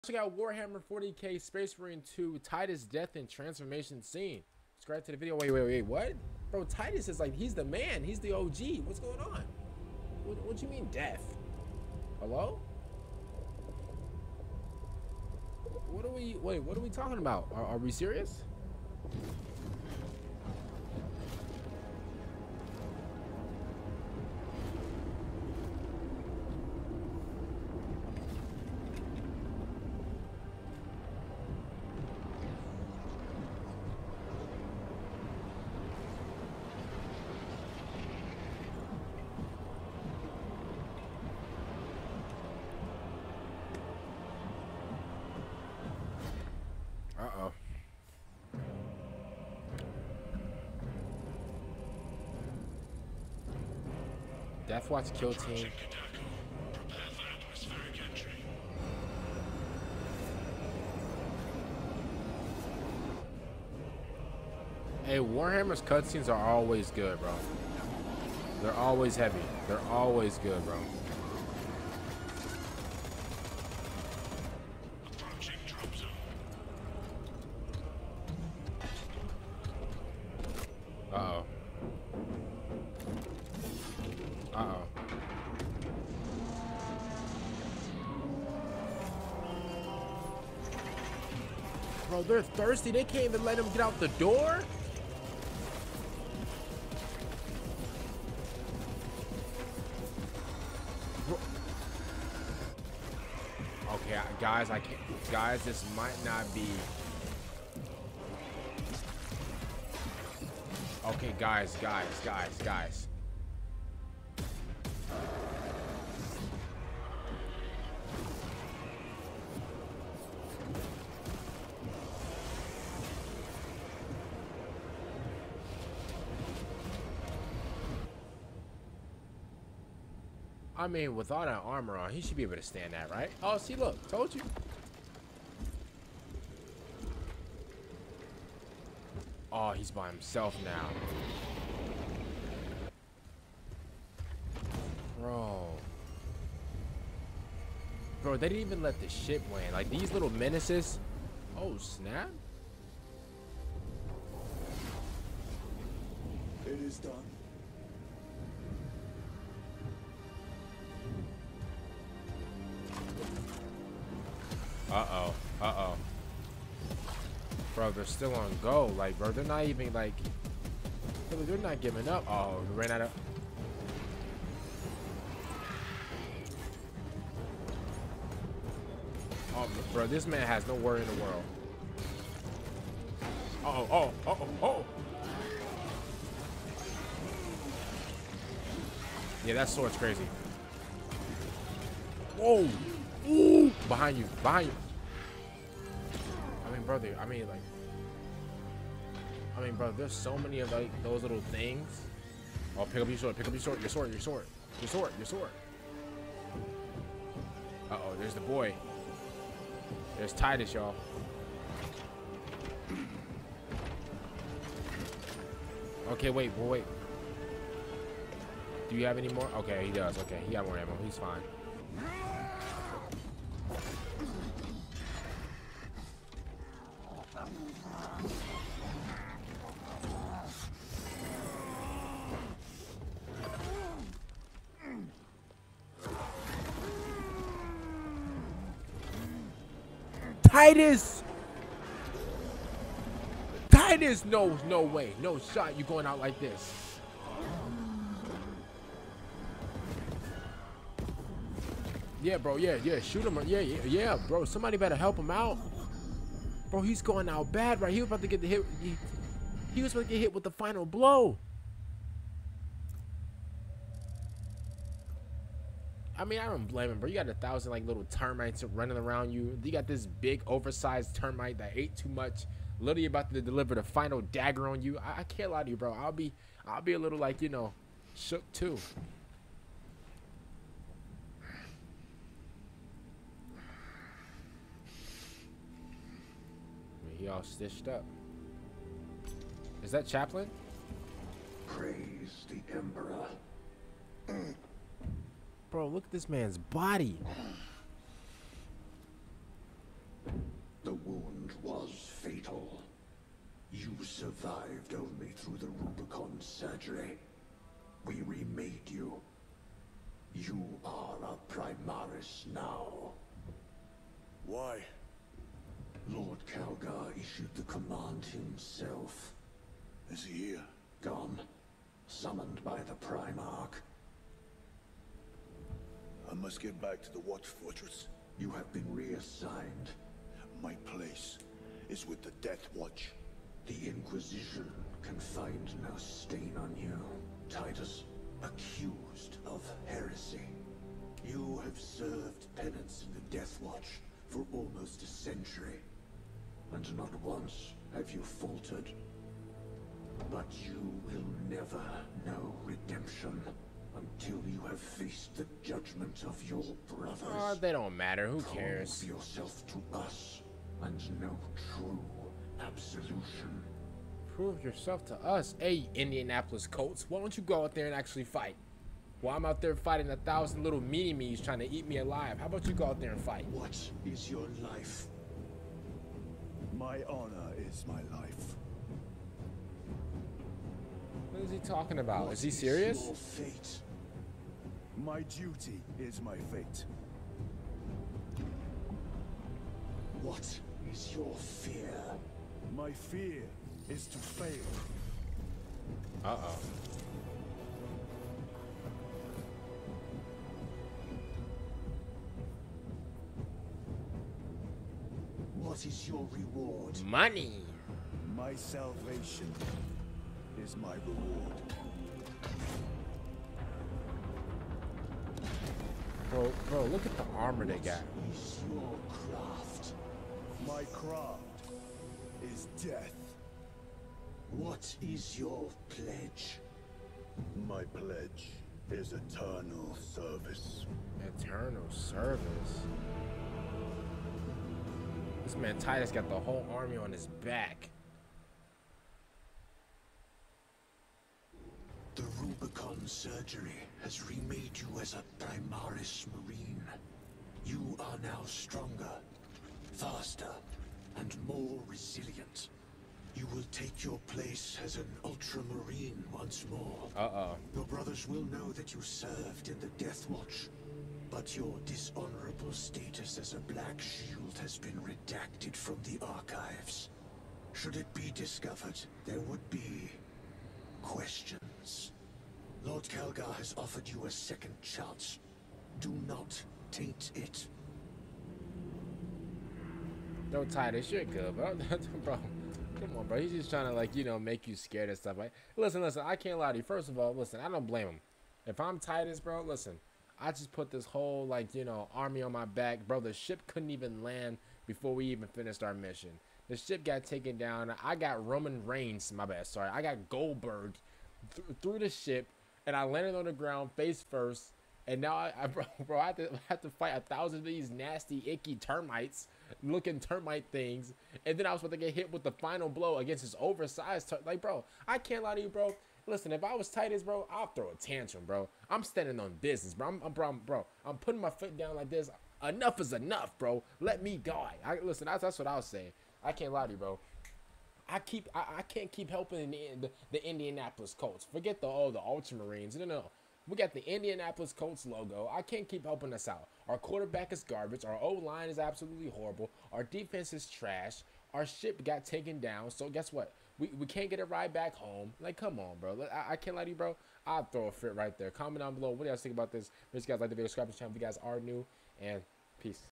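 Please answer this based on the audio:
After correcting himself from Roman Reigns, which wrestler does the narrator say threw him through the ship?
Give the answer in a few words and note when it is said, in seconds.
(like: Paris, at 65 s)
Goldberg, at 500 s.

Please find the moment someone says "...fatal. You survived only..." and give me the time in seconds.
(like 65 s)
302 s.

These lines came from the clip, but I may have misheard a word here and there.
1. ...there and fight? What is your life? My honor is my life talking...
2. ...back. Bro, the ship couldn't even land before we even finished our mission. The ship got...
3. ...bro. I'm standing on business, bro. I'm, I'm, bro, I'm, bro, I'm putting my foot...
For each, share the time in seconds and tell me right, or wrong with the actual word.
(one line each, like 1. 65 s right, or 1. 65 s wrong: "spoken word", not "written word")
1. 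372 s right
2. 492 s right
3. 518 s right.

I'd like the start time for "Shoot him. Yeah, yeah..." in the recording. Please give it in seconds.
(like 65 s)
252 s.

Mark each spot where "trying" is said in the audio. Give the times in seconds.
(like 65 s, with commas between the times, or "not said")
371 s, 483 s.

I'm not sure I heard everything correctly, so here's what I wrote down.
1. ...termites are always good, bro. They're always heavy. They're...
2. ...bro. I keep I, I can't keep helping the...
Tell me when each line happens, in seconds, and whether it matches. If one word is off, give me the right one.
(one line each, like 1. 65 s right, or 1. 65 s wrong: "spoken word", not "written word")
1. 65 s wrong: "cutscenes", not "termites"
2. 526 s right.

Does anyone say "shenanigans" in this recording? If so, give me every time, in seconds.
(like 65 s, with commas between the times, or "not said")
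not said.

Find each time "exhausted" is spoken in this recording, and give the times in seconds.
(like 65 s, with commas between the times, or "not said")
not said.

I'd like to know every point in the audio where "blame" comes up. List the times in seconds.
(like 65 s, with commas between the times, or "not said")
266 s, 487 s.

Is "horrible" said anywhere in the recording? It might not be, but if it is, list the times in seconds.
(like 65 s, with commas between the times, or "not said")
539 s.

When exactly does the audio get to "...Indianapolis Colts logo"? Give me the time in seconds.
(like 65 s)
534 s.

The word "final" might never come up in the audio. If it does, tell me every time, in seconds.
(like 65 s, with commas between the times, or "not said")
260 s, 273 s, 512 s.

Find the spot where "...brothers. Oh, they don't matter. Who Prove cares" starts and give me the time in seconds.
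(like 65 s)
356 s.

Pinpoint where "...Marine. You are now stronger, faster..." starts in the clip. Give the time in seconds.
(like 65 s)
446 s.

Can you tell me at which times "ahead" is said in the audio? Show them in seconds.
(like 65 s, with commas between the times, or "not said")
not said.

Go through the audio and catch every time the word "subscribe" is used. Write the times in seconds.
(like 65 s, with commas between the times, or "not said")
4 s, 550 s.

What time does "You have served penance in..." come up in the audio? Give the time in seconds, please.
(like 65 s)
341 s.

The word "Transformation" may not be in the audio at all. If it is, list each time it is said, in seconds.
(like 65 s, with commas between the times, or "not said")
3 s.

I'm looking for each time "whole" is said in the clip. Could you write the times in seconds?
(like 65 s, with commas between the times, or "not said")
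436 s, 491 s.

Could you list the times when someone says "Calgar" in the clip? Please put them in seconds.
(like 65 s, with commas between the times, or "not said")
316 s, 473 s.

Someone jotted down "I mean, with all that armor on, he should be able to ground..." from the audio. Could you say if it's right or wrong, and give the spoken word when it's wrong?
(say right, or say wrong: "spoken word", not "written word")
wrong: "stand", not "ground".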